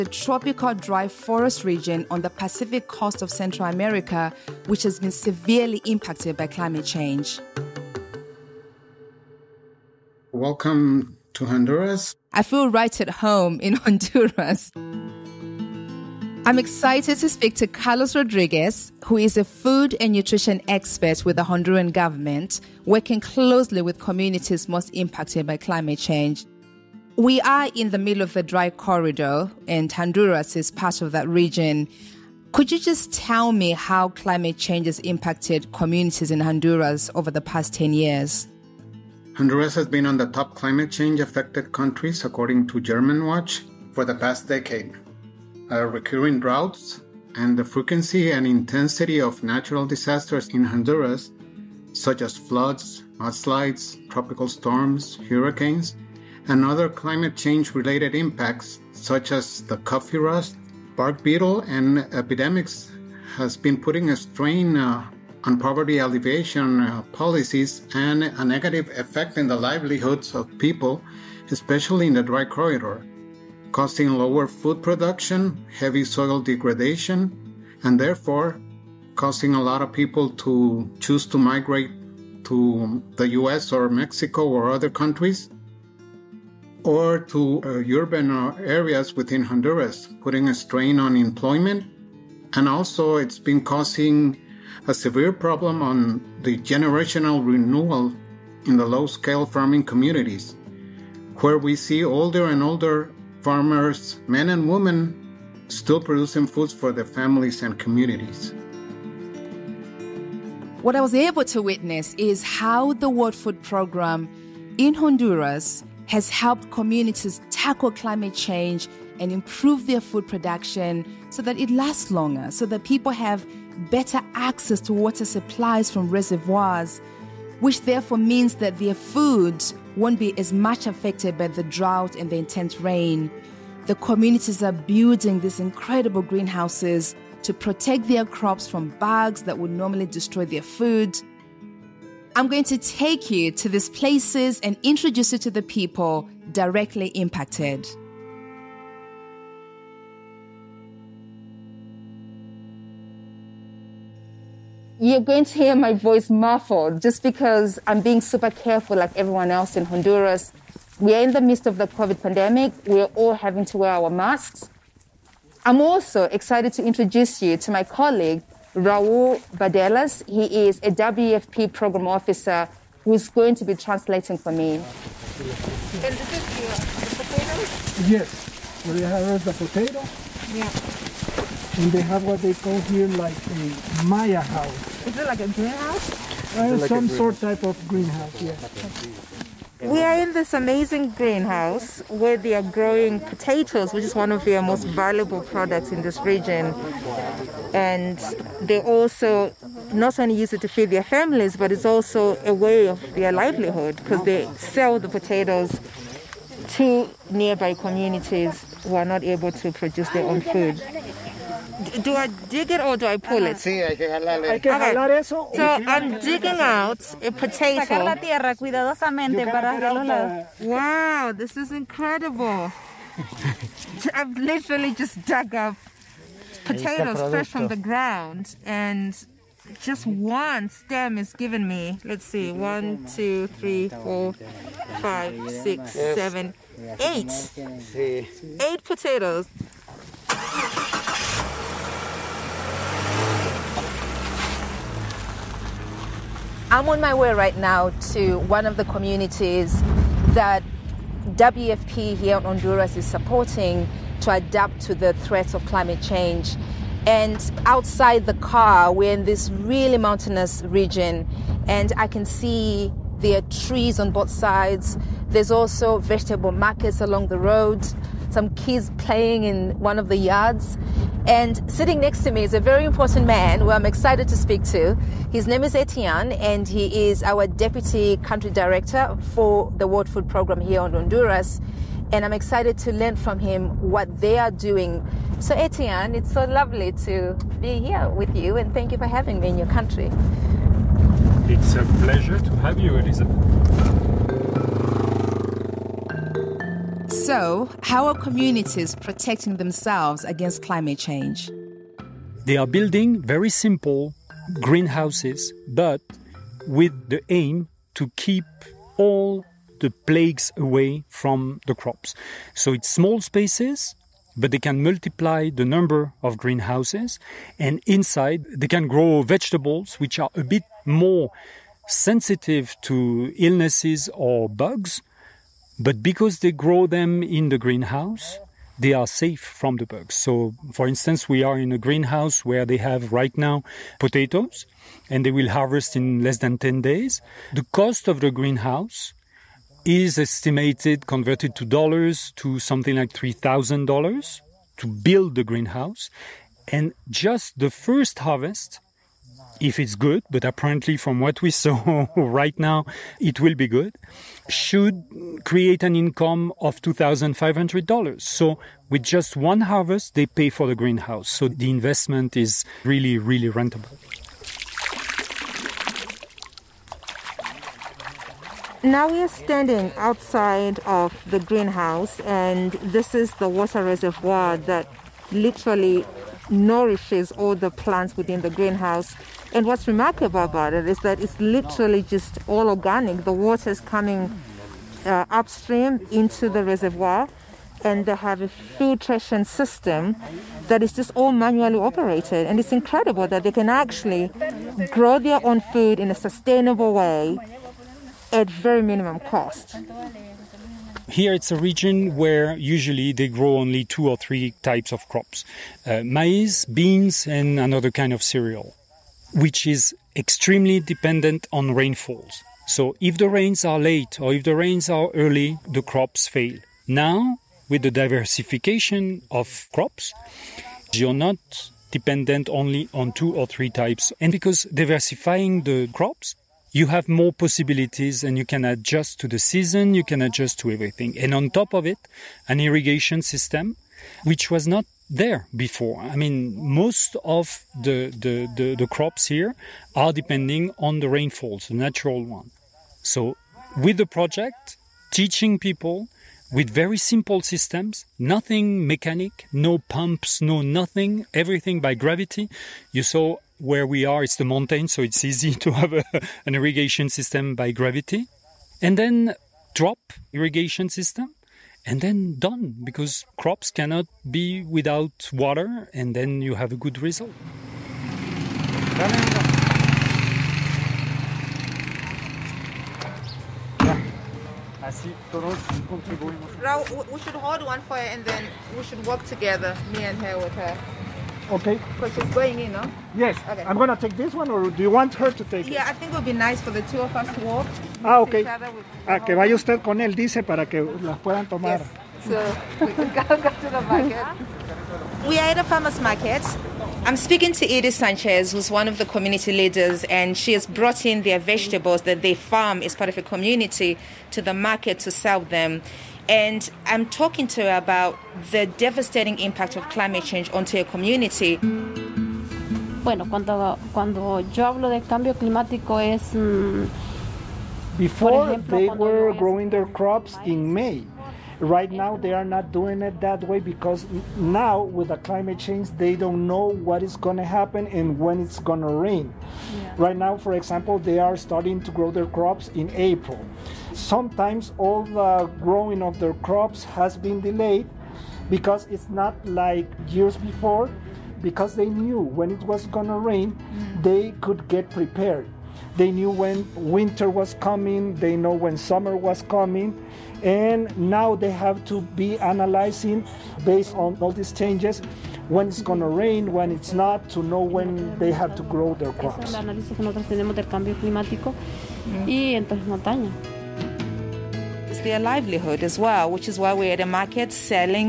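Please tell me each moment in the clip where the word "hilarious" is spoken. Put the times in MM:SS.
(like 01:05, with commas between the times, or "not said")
not said.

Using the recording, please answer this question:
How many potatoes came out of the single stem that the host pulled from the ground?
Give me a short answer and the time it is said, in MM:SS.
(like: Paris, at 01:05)
8, at 03:57.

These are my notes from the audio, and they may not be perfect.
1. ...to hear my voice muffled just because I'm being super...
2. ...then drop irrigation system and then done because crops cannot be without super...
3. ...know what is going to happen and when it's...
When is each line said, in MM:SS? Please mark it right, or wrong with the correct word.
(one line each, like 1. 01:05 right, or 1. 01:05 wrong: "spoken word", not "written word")
1. 02:35 right
2. 07:38 wrong: "water", not "super"
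3. 08:46 right.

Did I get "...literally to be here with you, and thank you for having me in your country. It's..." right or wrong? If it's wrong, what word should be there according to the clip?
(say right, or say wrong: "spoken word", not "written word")
wrong: "lovely", not "literally".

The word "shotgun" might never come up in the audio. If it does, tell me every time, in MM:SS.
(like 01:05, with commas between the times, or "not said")
not said.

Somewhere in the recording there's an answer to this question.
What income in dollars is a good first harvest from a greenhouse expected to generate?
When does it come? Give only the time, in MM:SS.
05:56.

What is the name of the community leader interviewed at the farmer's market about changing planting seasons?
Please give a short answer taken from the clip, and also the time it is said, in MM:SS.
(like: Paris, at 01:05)
Edith Sanchez, at 08:17.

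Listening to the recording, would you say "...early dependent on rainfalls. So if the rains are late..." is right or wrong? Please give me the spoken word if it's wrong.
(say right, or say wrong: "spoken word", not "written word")
wrong: "extremely", not "early".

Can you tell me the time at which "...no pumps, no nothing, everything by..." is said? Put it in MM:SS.
07:29.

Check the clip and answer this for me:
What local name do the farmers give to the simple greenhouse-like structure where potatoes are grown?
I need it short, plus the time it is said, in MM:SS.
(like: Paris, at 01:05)
Maya house, at 03:04.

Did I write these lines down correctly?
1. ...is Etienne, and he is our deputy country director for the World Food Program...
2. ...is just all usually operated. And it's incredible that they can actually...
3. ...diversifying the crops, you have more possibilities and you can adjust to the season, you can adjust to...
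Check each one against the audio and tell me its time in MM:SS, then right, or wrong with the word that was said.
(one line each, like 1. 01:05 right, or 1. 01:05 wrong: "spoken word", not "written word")
1. 04:35 right
2. 06:30 wrong: "manually", not "usually"
3. 07:04 right.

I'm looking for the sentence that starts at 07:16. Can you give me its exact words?
I mean, most of the, the, the, the, crops here are depending on the rainfalls, the natural one.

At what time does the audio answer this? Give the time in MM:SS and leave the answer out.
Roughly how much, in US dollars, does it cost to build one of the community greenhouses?
05:43.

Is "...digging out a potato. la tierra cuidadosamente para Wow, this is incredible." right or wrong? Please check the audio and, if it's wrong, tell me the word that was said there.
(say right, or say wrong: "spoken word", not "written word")
right.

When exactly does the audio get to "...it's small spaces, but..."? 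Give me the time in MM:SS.
05:12.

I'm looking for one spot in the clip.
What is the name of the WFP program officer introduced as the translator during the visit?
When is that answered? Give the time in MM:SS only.
02:48.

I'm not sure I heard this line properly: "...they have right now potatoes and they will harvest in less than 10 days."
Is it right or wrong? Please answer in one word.
right.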